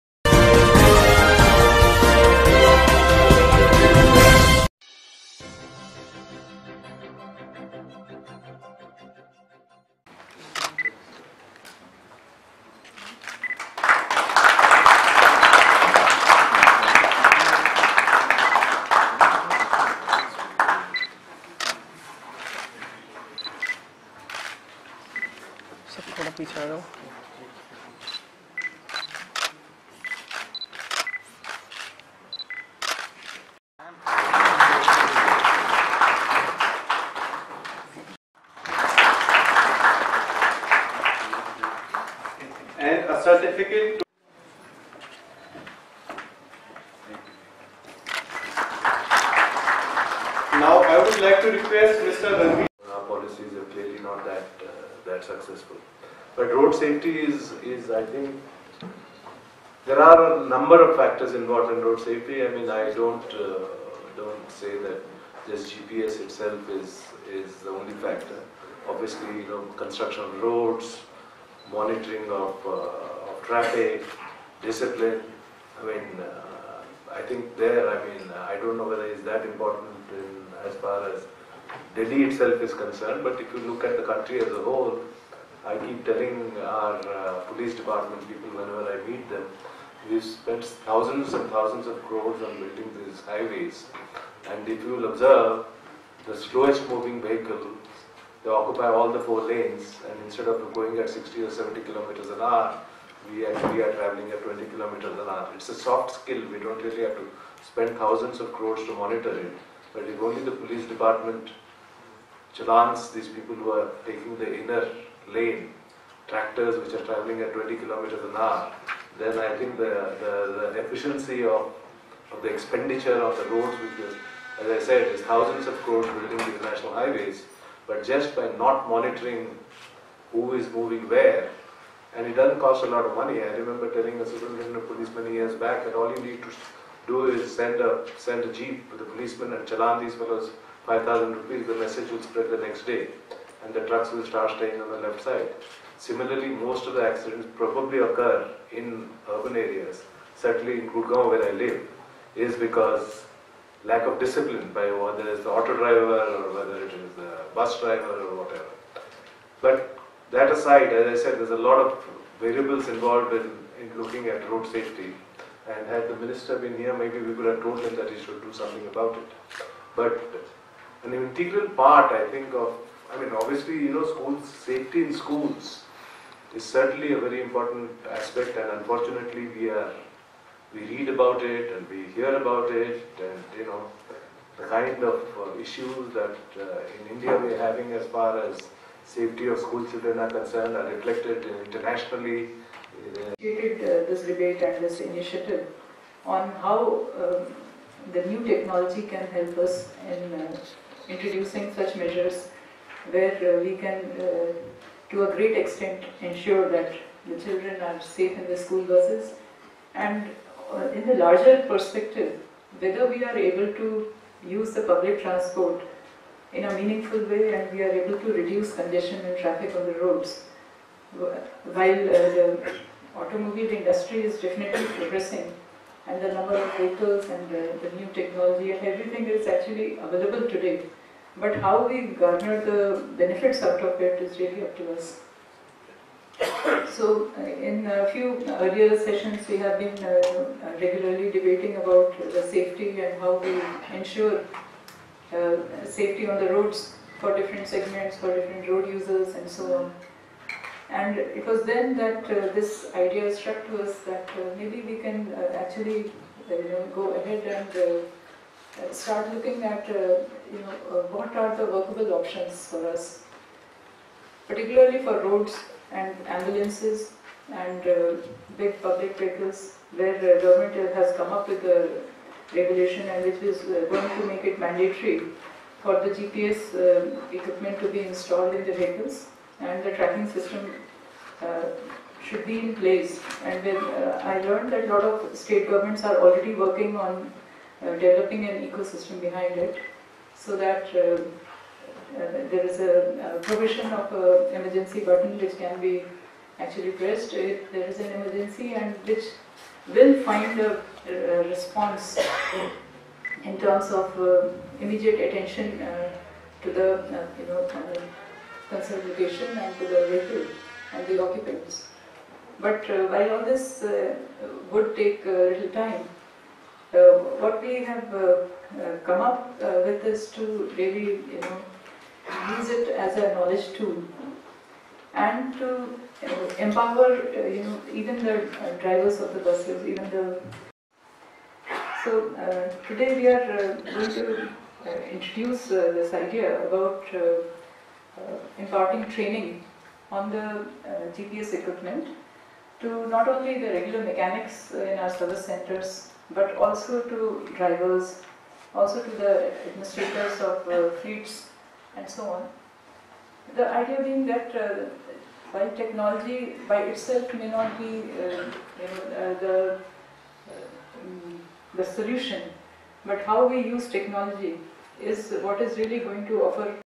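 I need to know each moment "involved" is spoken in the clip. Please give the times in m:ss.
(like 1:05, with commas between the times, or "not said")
1:01, 2:42.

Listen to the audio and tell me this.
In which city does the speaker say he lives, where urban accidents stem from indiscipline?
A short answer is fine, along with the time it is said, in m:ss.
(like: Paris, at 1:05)
Gurgaon, at 2:30.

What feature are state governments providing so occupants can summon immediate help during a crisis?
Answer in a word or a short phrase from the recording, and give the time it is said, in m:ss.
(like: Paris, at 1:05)
emergency button, at 4:54.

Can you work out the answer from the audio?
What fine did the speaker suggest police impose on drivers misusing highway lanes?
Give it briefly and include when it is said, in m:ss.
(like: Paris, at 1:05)
5,000 rupees, at 2:20.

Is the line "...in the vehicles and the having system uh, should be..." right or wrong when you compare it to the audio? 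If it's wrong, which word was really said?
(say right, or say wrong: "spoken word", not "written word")
wrong: "tracking", not "having".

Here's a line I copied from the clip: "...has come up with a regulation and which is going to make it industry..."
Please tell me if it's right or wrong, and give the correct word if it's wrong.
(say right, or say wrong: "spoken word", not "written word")
wrong: "mandatory", not "industry".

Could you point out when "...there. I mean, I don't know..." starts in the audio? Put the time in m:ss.
1:17.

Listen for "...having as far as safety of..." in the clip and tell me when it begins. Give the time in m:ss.
3:07.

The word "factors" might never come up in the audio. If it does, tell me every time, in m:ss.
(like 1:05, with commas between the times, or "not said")
1:00, 1:07.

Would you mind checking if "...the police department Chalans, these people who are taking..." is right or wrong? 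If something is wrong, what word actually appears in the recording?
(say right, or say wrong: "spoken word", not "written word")
right.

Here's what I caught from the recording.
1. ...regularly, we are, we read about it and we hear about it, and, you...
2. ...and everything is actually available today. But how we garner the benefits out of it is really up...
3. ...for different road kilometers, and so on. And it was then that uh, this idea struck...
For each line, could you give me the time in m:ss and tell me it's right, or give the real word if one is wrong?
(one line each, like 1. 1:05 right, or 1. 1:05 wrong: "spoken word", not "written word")
1. 2:58 wrong: "unfortunately", not "regularly"
2. 3:48 right
3. 4:08 wrong: "users", not "kilometers".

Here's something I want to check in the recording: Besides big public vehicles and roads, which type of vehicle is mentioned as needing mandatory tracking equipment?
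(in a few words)
ambulances.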